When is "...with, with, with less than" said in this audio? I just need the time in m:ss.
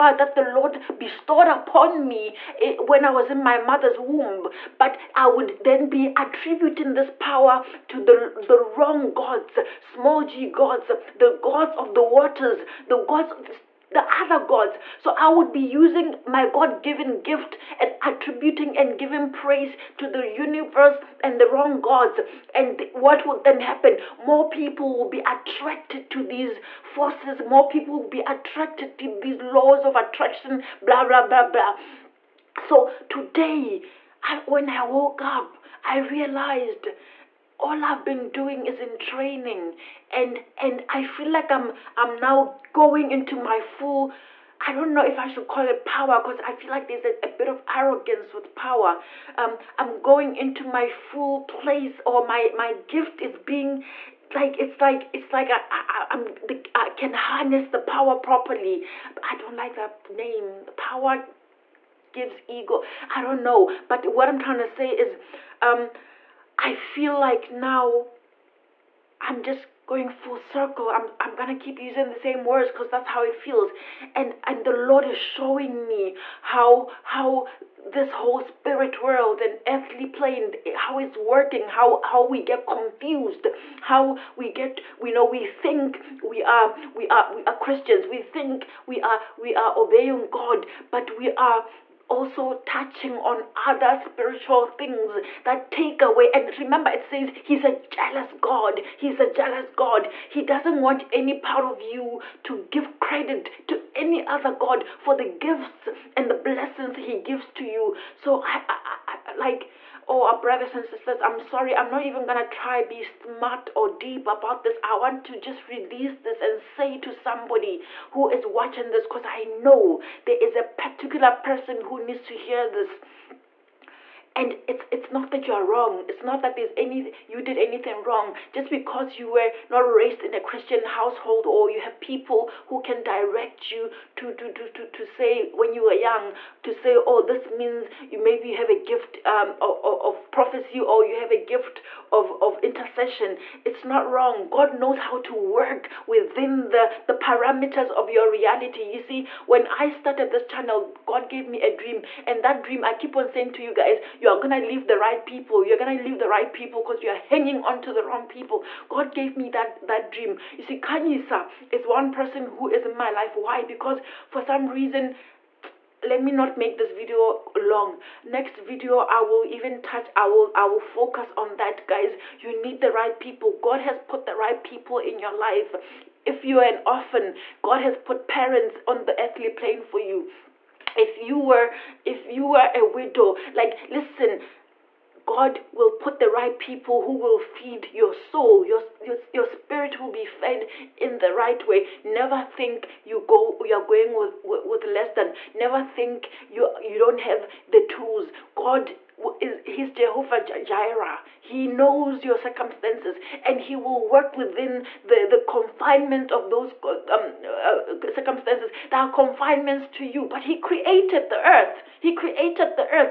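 3:14.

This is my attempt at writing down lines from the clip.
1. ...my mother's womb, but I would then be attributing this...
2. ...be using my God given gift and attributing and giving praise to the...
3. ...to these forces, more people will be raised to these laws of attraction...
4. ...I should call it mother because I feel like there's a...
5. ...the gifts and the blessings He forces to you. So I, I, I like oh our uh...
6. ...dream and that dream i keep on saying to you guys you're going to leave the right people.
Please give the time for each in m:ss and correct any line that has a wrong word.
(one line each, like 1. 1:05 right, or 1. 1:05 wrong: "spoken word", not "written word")
1. 0:03 right
2. 0:15 right
3. 0:26 wrong: "attracted", not "raised"
4. 0:45 wrong: "power", not "mother"
5. 1:45 wrong: "gives", not "forces"
6. 2:31 right.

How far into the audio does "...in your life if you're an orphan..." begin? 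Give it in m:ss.
2:54.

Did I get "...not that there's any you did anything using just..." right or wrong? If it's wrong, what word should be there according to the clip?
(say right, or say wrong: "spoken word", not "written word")
wrong: "wrong", not "using".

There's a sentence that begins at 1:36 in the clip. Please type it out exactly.
And remember, it says He's a jealous God.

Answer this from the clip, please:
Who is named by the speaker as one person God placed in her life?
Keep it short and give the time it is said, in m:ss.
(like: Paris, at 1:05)
Kanyisa, at 2:40.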